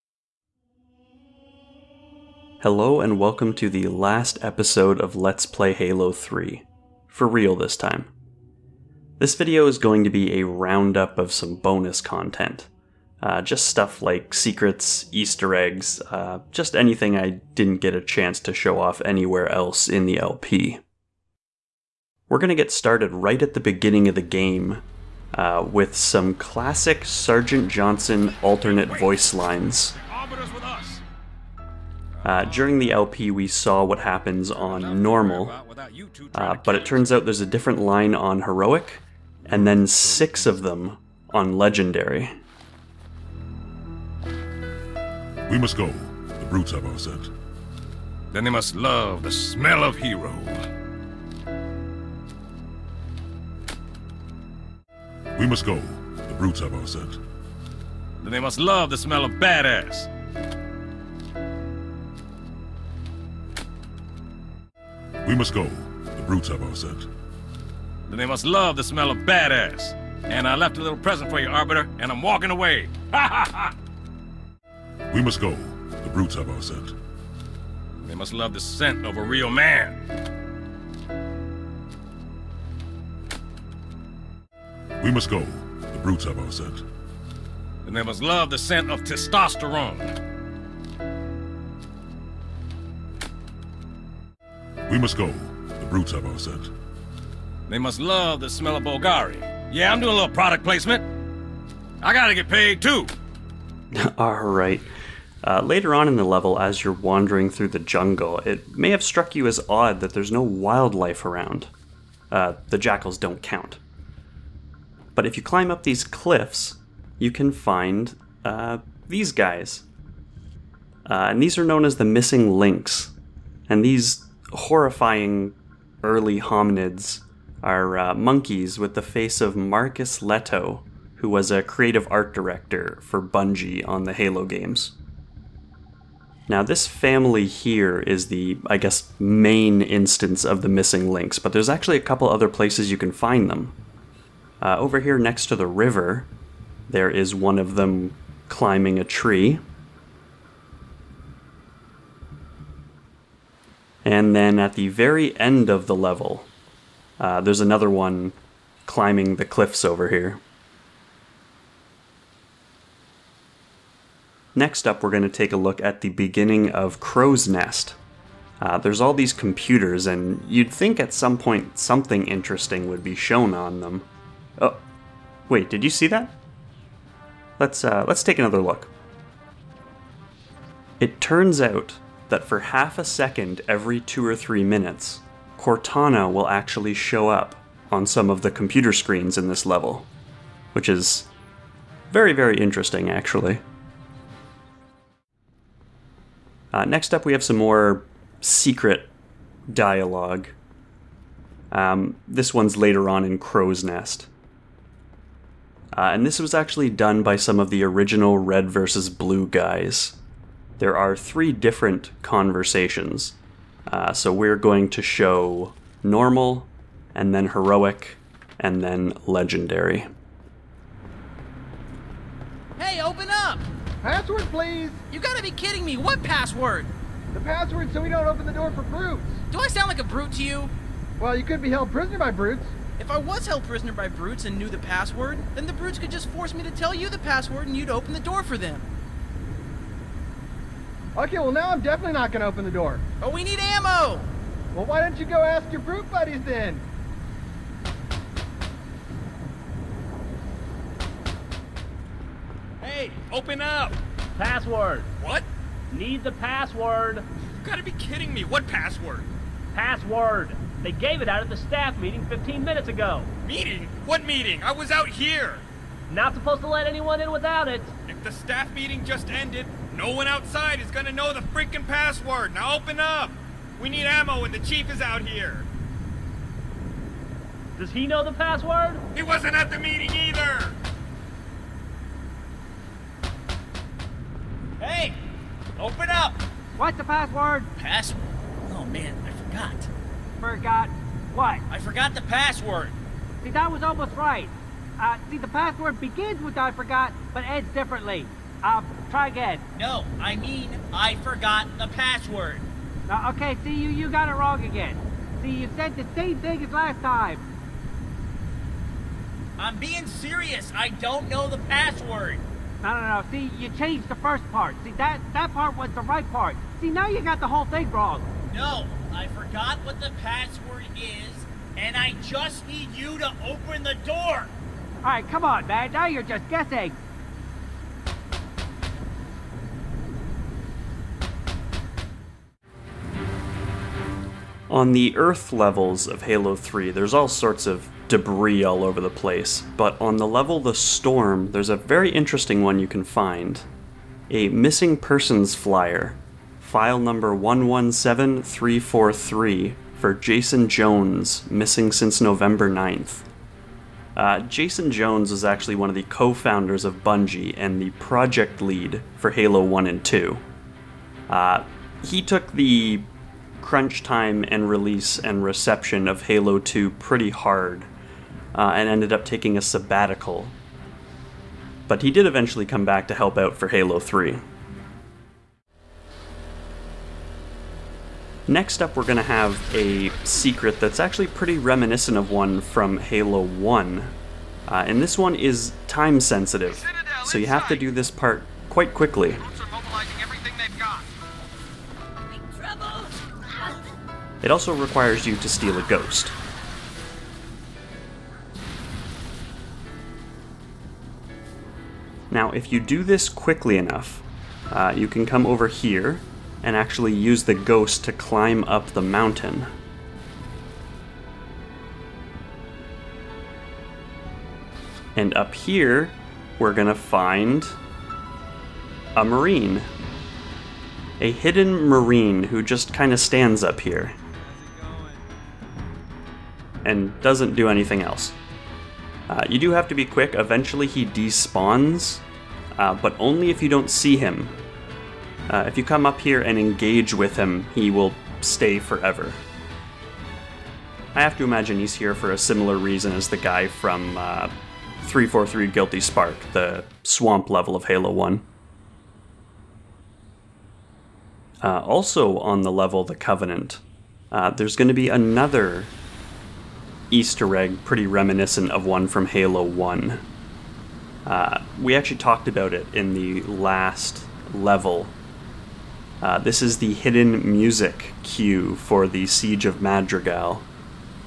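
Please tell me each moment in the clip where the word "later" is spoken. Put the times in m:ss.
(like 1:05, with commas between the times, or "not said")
1:45, 3:22.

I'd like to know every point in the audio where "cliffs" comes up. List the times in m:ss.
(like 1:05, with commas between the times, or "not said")
1:56, 2:39.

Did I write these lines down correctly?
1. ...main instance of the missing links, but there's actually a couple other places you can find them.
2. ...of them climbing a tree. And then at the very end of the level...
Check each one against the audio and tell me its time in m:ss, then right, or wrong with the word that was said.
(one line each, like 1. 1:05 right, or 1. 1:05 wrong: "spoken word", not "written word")
1. 2:19 right
2. 2:27 right.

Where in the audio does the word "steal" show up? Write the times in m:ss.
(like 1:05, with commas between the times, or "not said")
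6:35.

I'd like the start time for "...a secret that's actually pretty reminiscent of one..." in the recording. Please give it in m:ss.
6:19.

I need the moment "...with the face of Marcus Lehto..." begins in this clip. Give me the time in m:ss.
2:08.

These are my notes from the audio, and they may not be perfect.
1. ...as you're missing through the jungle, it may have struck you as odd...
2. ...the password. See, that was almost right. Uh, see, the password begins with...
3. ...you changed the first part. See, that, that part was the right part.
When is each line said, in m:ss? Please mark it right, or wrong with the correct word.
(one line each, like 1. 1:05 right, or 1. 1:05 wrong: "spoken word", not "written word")
1. 1:46 wrong: "wandering", not "missing"
2. 4:52 right
3. 5:13 right.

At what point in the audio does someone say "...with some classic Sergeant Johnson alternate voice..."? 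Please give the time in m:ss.
0:25.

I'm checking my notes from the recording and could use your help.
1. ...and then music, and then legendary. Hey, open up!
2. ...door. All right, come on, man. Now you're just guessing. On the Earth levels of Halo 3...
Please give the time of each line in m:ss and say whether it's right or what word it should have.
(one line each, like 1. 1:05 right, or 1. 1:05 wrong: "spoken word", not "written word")
1. 3:37 wrong: "heroic", not "music"
2. 5:24 right.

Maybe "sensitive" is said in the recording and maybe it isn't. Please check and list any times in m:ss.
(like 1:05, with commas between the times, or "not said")
6:26.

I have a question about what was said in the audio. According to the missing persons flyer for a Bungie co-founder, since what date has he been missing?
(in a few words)
November 9th.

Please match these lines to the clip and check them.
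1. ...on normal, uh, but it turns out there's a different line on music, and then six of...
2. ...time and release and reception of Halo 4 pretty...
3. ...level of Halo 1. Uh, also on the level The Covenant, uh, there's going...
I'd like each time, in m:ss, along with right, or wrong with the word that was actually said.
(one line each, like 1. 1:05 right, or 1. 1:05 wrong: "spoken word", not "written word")
1. 0:34 wrong: "heroic", not "music"
2. 6:04 wrong: "2", not "4"
3. 7:27 right.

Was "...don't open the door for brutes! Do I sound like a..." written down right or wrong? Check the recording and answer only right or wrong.
right.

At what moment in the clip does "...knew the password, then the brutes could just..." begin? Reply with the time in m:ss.
3:54.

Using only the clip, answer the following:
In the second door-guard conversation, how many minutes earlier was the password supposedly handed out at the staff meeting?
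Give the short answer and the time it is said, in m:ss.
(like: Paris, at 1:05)
15, at 4:22.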